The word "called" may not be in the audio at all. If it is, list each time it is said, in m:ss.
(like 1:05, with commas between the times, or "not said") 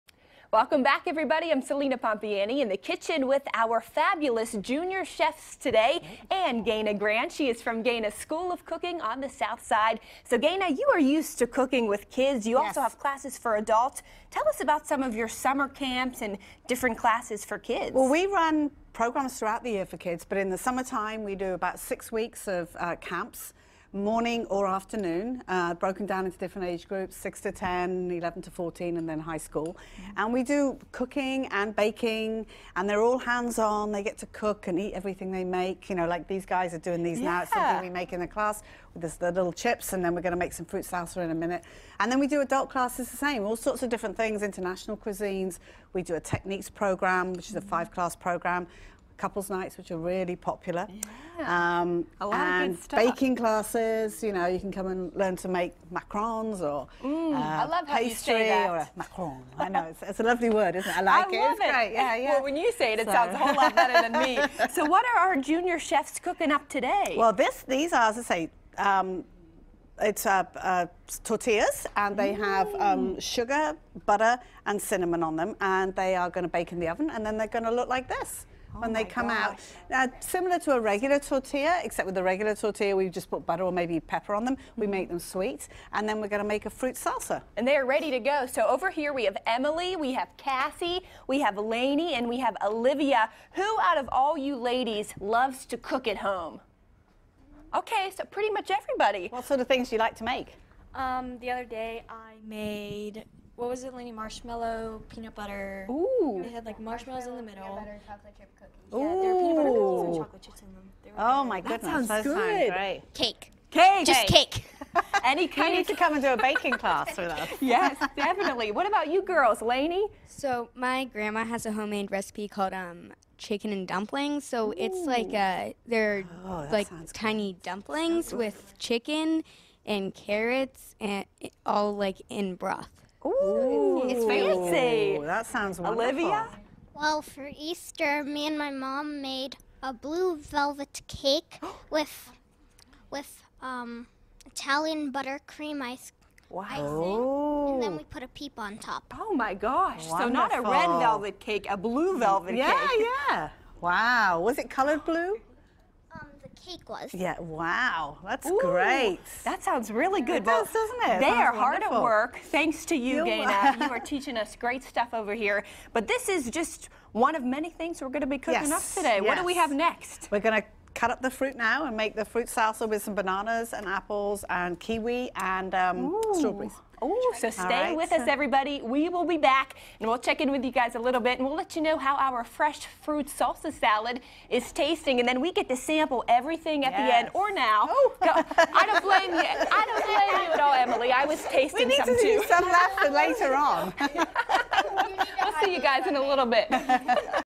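2:02.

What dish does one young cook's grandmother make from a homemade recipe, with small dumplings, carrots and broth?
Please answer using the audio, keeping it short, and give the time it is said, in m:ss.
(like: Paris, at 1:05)
Chicken and dumplings, at 2:03.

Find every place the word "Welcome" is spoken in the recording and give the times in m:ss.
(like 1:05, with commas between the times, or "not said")
0:00.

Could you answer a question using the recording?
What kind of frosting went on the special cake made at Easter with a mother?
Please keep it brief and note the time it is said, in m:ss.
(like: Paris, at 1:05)
Italian buttercream, at 2:24.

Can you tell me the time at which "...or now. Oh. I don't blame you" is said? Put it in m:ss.
3:07.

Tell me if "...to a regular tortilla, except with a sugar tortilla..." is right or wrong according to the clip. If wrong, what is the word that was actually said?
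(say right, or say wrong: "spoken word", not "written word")
wrong: "regular", not "sugar".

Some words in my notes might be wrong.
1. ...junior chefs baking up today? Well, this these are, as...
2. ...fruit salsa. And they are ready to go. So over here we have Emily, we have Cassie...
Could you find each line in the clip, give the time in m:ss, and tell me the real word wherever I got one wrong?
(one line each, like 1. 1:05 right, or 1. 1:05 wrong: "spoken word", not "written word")
1. 1:05 wrong: "cooking", not "baking"
2. 1:26 right.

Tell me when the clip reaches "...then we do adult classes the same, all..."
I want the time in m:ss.
0:42.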